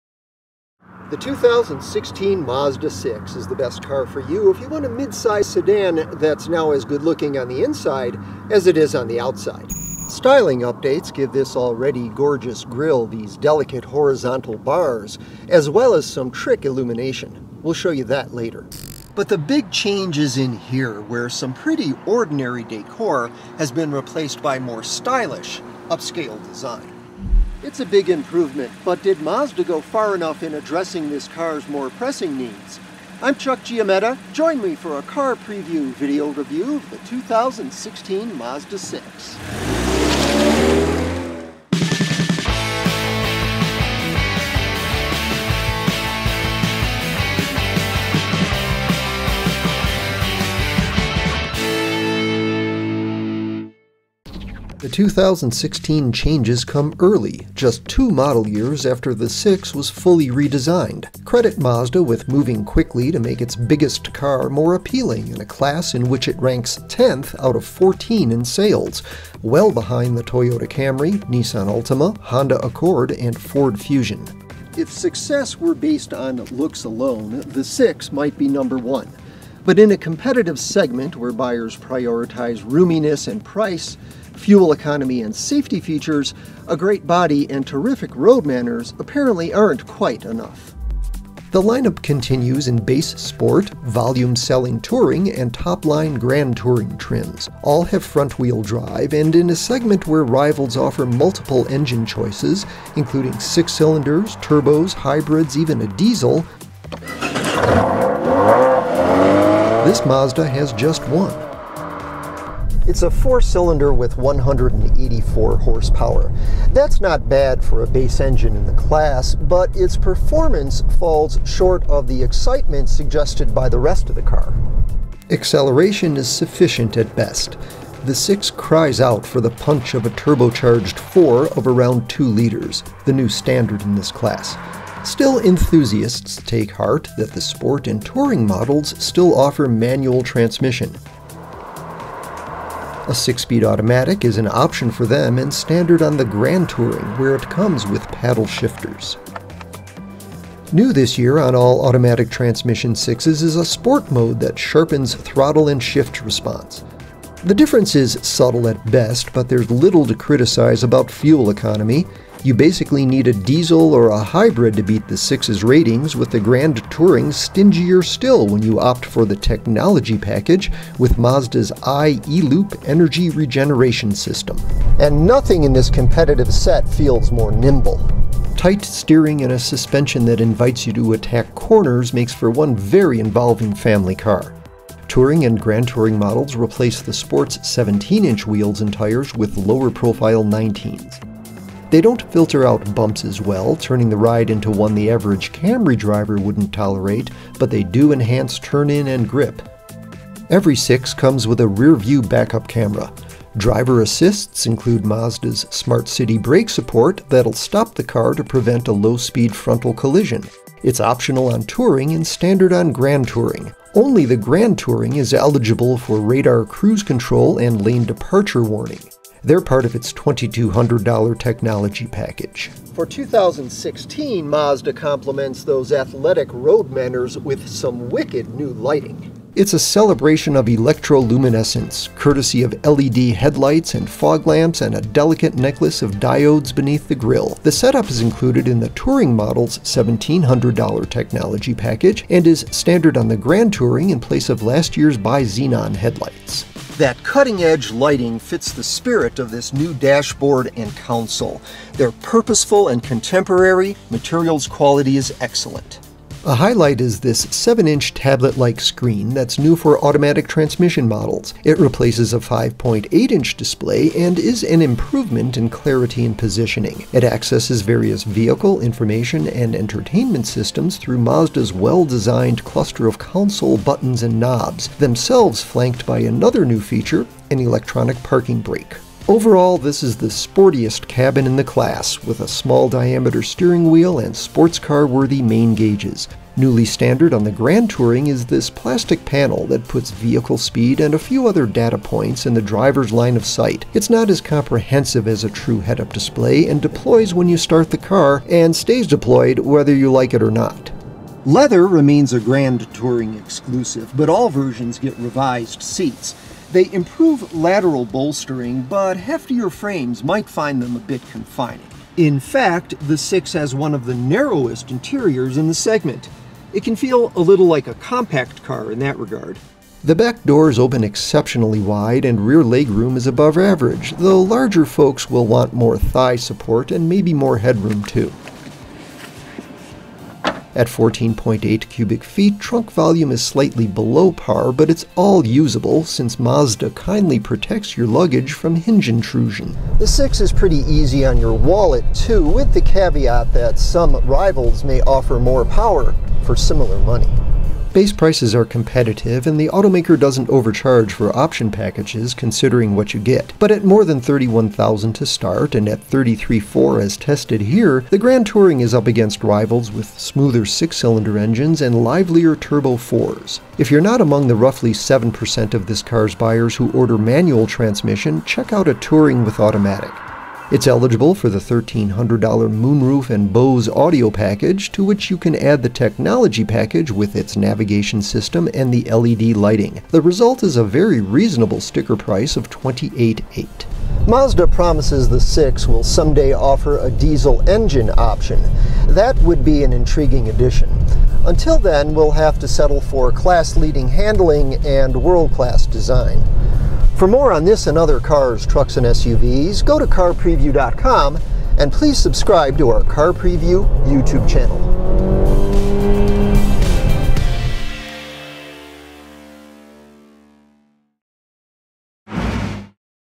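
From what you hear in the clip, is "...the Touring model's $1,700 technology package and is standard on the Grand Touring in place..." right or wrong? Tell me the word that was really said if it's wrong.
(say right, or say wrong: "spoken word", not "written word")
right.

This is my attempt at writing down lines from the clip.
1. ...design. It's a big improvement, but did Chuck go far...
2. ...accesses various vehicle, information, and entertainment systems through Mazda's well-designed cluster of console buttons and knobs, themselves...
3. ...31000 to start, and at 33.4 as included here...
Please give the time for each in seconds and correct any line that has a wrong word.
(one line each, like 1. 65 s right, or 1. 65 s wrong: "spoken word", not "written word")
1. 26 s wrong: "Mazda", not "Chuck"
2. 267 s right
3. 354 s wrong: "tested", not "included".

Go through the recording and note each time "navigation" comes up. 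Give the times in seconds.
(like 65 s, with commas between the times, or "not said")
377 s.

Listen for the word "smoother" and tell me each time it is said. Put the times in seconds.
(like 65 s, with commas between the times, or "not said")
360 s.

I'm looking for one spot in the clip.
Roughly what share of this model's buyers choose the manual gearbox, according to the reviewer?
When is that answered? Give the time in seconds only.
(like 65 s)
364 s.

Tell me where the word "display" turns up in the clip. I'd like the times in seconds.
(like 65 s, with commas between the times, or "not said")
263 s, 296 s.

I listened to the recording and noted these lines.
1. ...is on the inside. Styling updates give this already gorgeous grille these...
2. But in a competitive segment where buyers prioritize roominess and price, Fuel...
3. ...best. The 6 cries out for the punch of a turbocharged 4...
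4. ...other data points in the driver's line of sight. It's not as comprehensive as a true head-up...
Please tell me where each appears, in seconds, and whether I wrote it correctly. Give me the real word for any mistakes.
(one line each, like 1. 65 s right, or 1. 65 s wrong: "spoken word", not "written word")
1. 8 s wrong: "outside", not "inside"
2. 79 s right
3. 127 s right
4. 291 s right.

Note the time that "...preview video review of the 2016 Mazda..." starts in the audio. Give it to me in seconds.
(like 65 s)
35 s.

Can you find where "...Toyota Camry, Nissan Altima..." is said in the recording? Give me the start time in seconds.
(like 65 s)
70 s.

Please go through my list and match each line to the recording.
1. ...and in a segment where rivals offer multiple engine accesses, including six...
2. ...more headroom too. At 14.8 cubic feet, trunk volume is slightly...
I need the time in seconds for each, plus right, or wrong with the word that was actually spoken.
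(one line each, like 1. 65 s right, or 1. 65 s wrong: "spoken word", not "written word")
1. 99 s wrong: "choices", not "accesses"
2. 327 s right.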